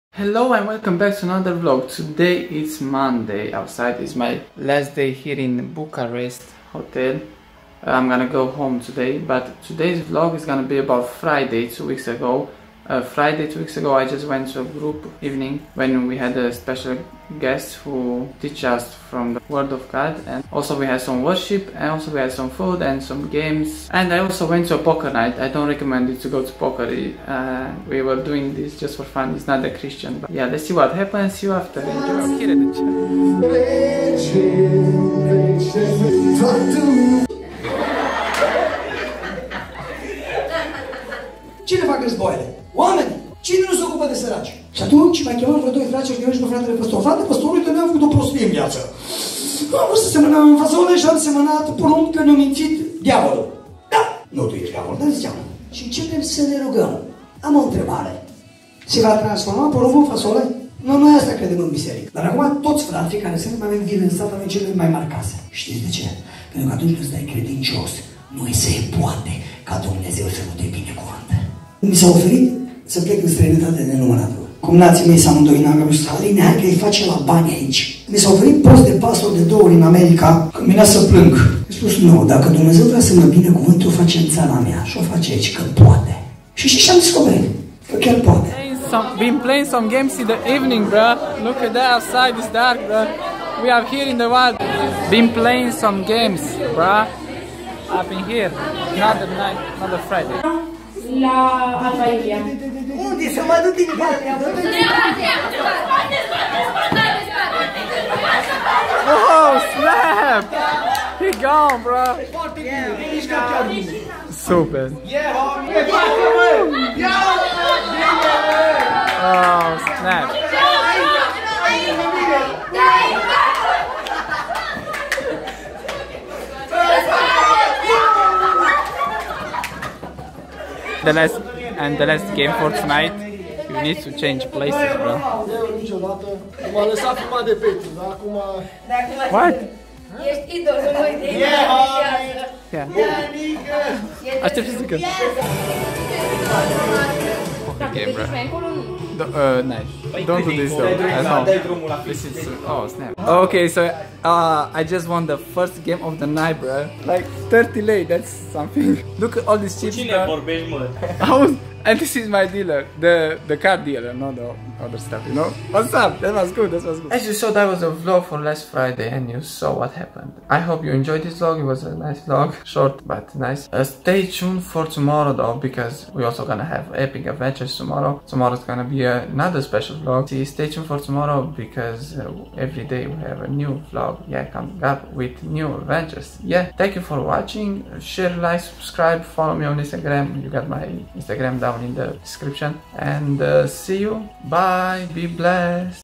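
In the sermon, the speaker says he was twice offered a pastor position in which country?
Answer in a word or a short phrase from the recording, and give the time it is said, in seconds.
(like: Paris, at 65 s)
America, at 79 s.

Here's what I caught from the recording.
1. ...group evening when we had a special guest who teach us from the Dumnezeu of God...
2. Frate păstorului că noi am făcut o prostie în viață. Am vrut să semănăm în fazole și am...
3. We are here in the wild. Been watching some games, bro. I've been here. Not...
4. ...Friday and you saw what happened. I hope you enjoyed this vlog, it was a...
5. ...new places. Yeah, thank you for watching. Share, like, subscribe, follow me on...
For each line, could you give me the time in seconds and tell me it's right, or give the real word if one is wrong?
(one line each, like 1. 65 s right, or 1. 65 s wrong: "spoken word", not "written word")
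1. 14 s wrong: "Word", not "Dumnezeu"
2. 47 s right
3. 93 s wrong: "playing", not "watching"
4. 168 s right
5. 185 s wrong: "adventures", not "places".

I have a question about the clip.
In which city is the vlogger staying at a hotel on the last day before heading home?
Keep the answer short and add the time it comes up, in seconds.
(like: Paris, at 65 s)
Bucharest, at 5 s.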